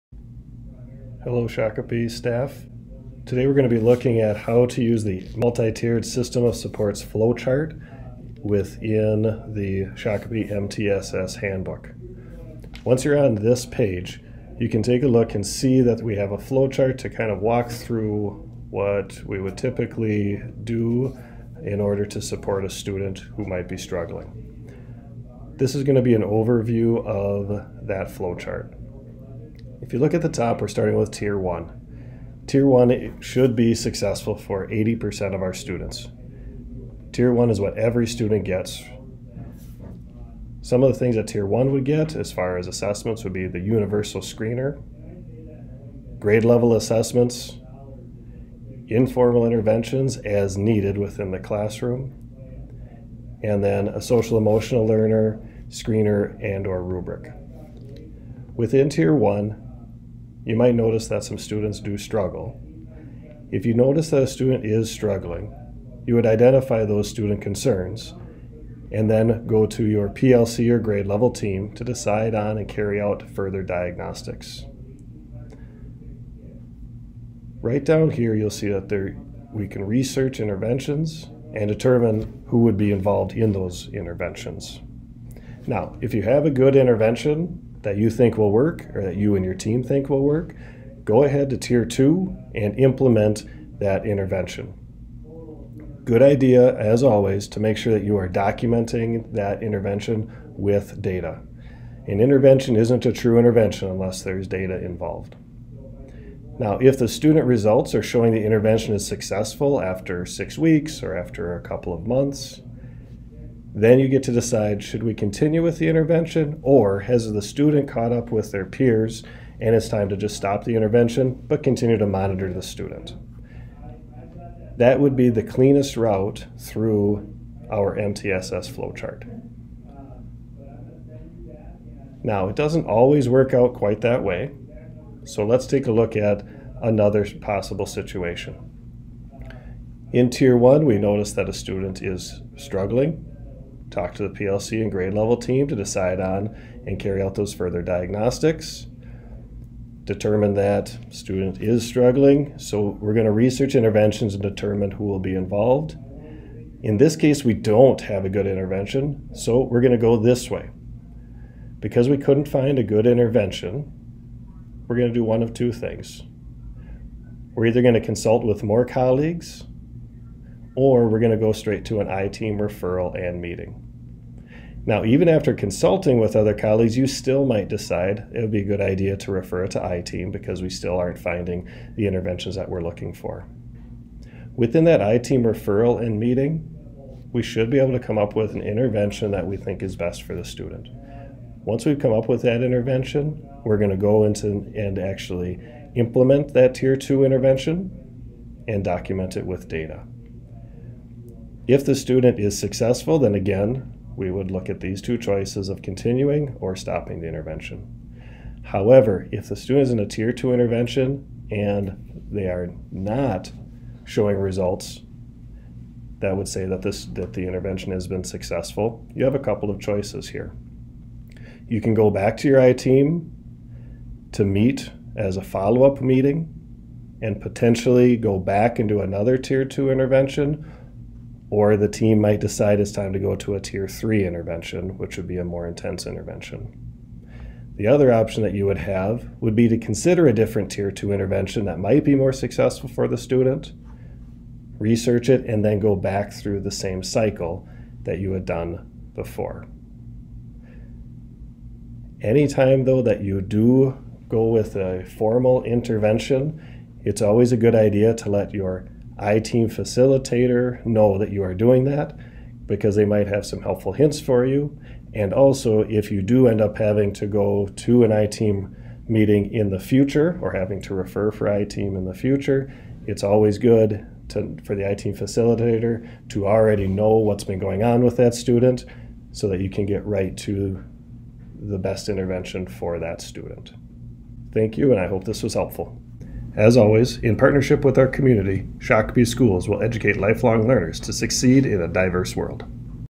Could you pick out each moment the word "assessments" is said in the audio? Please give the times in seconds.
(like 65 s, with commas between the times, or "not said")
42 s, 46 s.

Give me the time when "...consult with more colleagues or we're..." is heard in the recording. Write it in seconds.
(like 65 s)
168 s.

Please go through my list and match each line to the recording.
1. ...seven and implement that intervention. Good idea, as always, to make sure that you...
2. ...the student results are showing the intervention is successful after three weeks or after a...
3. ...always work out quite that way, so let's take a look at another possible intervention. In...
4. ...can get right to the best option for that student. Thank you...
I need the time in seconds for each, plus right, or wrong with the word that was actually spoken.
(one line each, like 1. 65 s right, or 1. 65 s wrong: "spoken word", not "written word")
1. 91 s wrong: "two", not "seven"
2. 106 s wrong: "six", not "three"
3. 132 s wrong: "situation", not "intervention"
4. 279 s wrong: "intervention", not "option".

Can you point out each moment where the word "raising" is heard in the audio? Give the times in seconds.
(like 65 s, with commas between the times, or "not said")
not said.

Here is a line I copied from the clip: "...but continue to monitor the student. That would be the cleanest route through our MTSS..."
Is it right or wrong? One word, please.
right.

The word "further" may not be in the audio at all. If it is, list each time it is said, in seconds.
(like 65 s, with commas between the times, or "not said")
73 s, 147 s.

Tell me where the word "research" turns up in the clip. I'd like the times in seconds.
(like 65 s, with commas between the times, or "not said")
79 s, 153 s, 244 s.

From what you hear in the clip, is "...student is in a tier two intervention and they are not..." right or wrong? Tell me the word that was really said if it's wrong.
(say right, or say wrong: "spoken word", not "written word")
right.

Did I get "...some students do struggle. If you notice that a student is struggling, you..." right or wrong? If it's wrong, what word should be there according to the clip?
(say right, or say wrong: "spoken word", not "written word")
right.